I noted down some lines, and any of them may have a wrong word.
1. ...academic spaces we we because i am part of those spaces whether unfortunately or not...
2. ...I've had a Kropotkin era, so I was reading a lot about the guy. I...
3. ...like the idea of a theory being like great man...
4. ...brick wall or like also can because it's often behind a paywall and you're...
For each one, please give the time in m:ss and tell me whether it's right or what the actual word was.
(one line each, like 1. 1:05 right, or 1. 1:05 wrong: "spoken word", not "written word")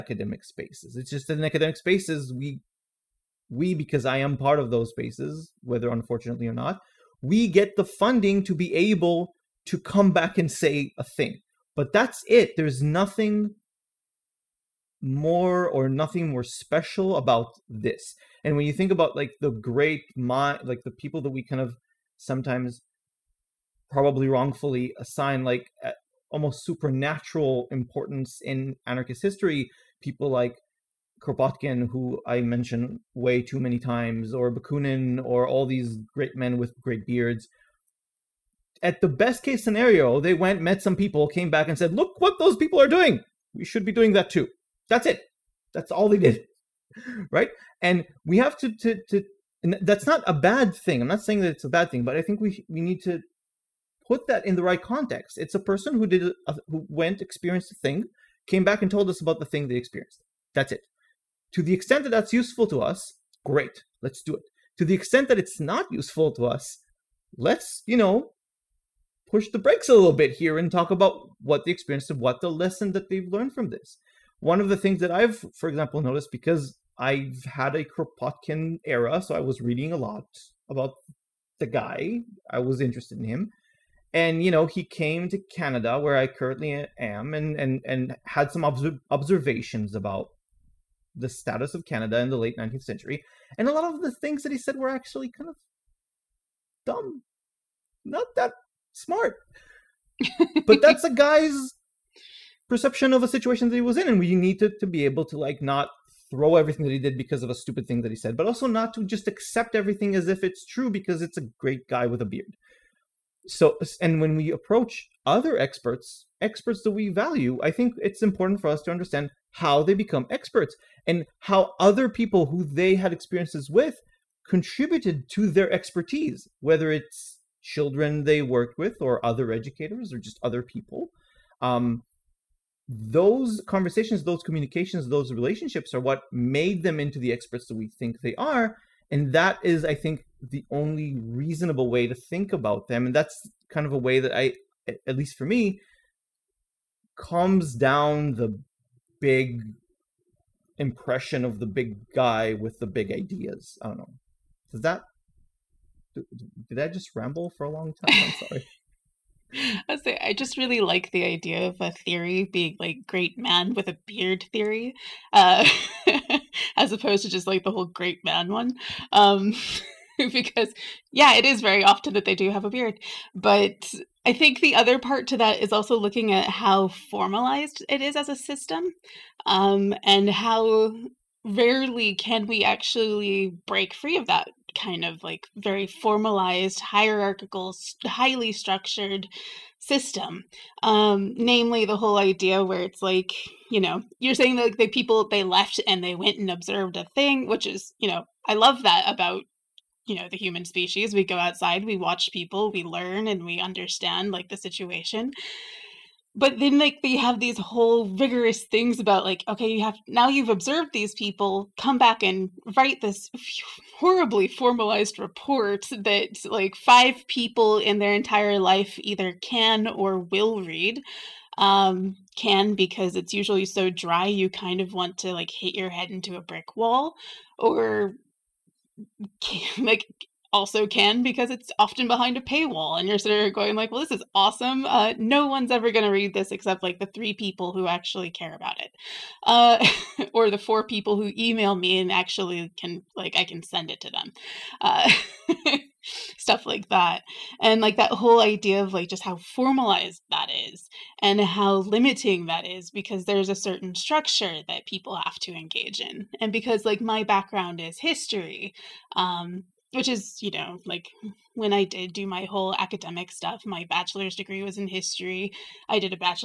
1. 0:01 right
2. 1:16 right
3. 2:40 right
4. 3:46 right.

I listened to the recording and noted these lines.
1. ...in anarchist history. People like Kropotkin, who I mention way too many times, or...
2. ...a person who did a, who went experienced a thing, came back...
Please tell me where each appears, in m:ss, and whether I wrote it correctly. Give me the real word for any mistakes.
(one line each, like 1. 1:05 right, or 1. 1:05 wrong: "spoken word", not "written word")
1. 0:28 right
2. 0:55 right.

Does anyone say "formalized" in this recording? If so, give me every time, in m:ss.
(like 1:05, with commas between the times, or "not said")
2:56, 3:05, 3:34, 4:09.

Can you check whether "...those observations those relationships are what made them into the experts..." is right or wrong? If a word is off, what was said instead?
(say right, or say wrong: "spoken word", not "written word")
wrong: "communications", not "observations".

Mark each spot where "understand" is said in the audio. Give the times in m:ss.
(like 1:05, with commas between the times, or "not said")
1:58, 3:23.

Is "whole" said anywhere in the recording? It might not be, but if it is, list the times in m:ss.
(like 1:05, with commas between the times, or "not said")
2:47, 3:11, 3:27, 4:08, 4:22.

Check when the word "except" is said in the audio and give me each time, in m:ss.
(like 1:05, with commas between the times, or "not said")
3:56.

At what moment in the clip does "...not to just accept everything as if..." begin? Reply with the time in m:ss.
1:48.